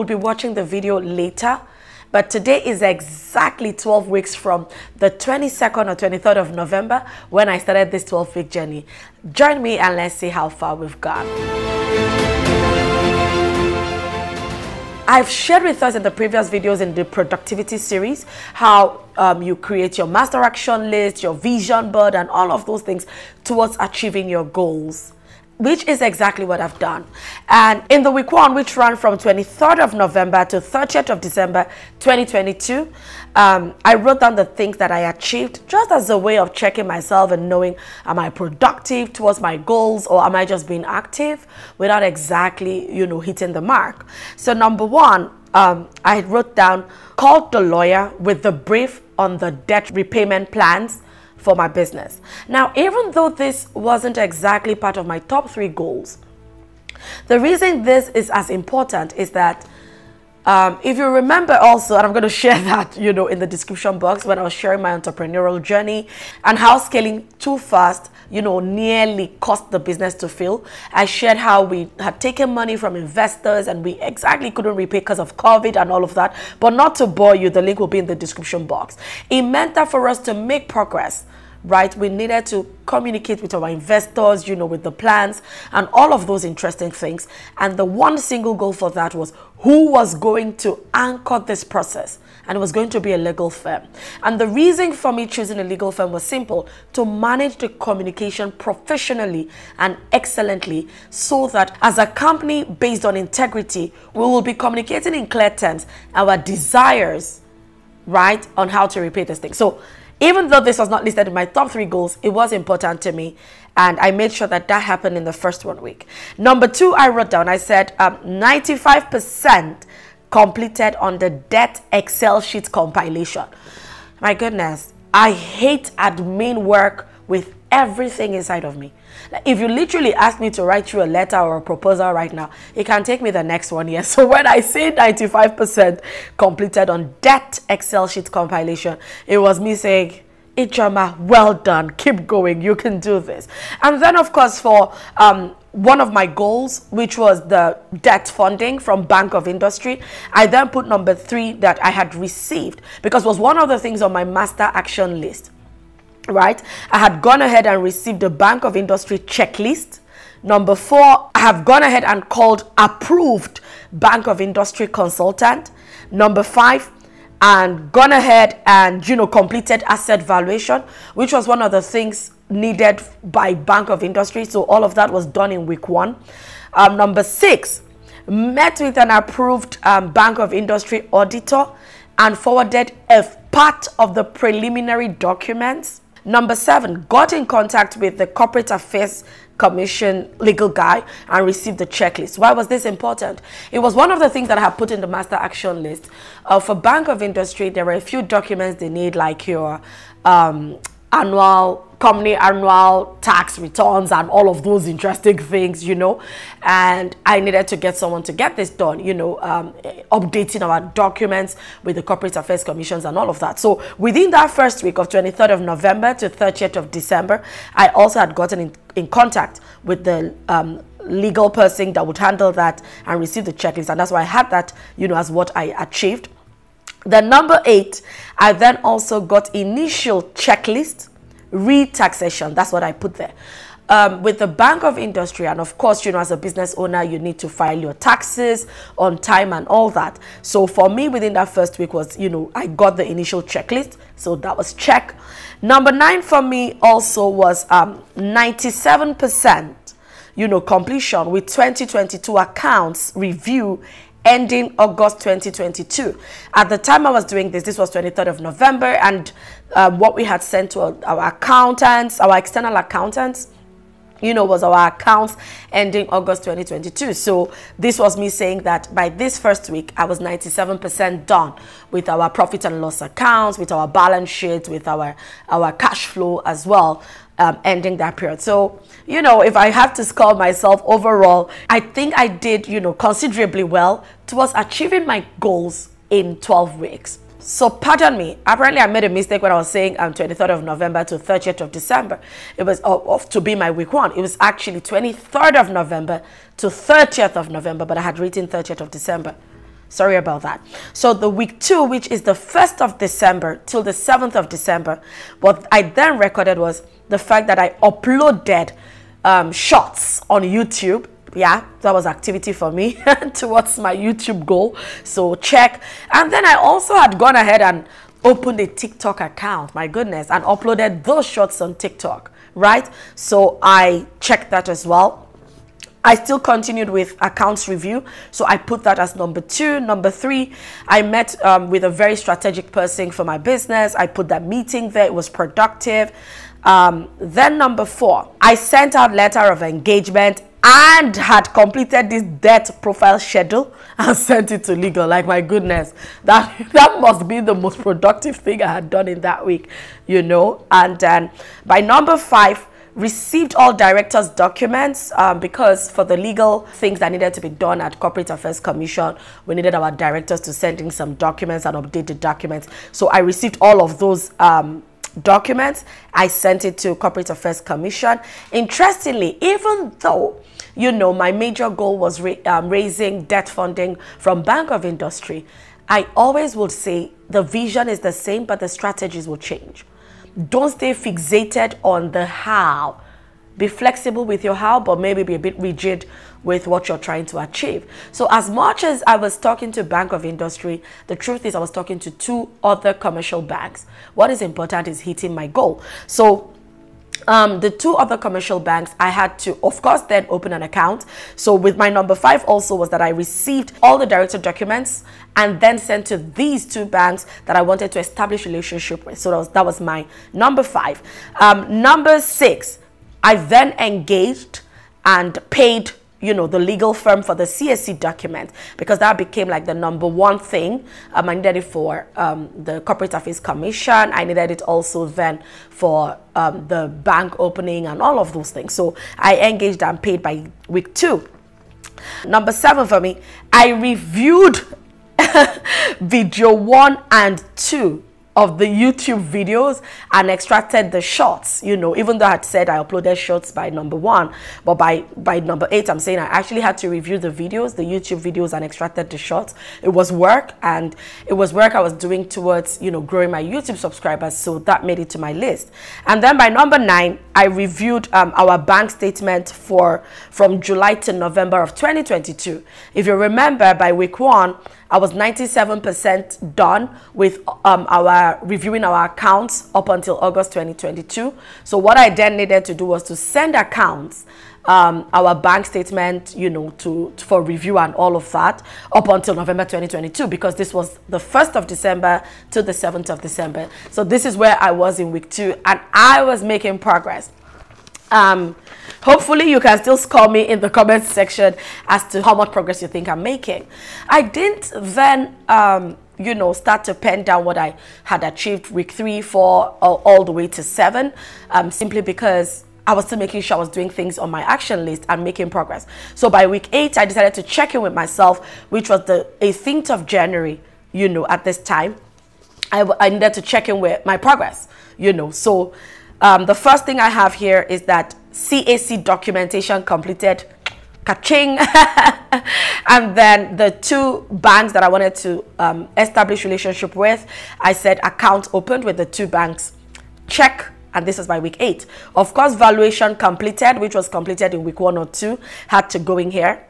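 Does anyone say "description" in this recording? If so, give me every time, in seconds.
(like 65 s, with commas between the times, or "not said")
63 s, 78 s.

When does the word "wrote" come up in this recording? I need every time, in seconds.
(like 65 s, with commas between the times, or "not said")
33 s, 46 s, 117 s.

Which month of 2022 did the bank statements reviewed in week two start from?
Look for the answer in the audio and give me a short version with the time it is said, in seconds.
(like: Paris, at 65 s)
July, at 460 s.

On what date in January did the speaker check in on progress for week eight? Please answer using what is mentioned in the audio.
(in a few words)
18th of January.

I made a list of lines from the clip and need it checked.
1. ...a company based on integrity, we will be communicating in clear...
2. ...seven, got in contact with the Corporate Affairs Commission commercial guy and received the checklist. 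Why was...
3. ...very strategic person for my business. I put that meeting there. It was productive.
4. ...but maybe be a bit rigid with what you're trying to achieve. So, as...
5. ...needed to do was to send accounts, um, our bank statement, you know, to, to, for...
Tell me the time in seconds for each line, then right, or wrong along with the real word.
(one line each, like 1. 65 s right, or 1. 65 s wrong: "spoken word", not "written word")
1. 101 s right
2. 186 s wrong: "legal", not "commercial"
3. 331 s right
4. 384 s right
5. 472 s right.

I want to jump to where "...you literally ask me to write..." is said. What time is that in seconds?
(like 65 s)
129 s.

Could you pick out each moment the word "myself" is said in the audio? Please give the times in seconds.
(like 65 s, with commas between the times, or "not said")
36 s, 280 s, 507 s.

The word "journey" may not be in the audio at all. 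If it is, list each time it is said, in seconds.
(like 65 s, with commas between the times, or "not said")
8 s, 65 s.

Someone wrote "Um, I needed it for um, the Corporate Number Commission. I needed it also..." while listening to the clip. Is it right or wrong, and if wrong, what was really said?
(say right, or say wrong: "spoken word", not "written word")
wrong: "Affairs", not "Number".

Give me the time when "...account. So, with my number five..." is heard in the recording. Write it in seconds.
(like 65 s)
400 s.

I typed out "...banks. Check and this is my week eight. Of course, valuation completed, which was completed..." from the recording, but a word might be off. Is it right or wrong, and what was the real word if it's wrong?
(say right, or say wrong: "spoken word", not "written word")
right.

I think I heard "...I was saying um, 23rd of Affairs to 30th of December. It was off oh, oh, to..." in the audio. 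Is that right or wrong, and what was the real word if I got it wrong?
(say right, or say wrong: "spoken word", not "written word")
wrong: "November", not "Affairs".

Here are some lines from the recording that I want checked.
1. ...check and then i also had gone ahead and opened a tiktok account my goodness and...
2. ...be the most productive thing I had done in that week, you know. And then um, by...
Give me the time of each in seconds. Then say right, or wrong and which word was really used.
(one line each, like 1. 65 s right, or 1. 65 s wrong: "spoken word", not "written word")
1. 315 s right
2. 347 s right.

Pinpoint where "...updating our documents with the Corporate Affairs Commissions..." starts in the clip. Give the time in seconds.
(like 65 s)
210 s.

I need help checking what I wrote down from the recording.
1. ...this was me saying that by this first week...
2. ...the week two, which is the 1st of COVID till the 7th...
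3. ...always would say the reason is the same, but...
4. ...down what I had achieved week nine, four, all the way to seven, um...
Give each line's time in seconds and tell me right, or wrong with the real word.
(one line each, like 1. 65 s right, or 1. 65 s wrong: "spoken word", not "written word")
1. 267 s right
2. 301 s wrong: "December", not "COVID"
3. 376 s wrong: "vision", not "reason"
4. 497 s wrong: "three", not "nine".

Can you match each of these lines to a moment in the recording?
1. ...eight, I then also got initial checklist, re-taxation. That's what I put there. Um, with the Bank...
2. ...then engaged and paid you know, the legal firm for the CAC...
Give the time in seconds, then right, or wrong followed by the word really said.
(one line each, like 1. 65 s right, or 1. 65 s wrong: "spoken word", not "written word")
1. 227 s right
2. 413 s right.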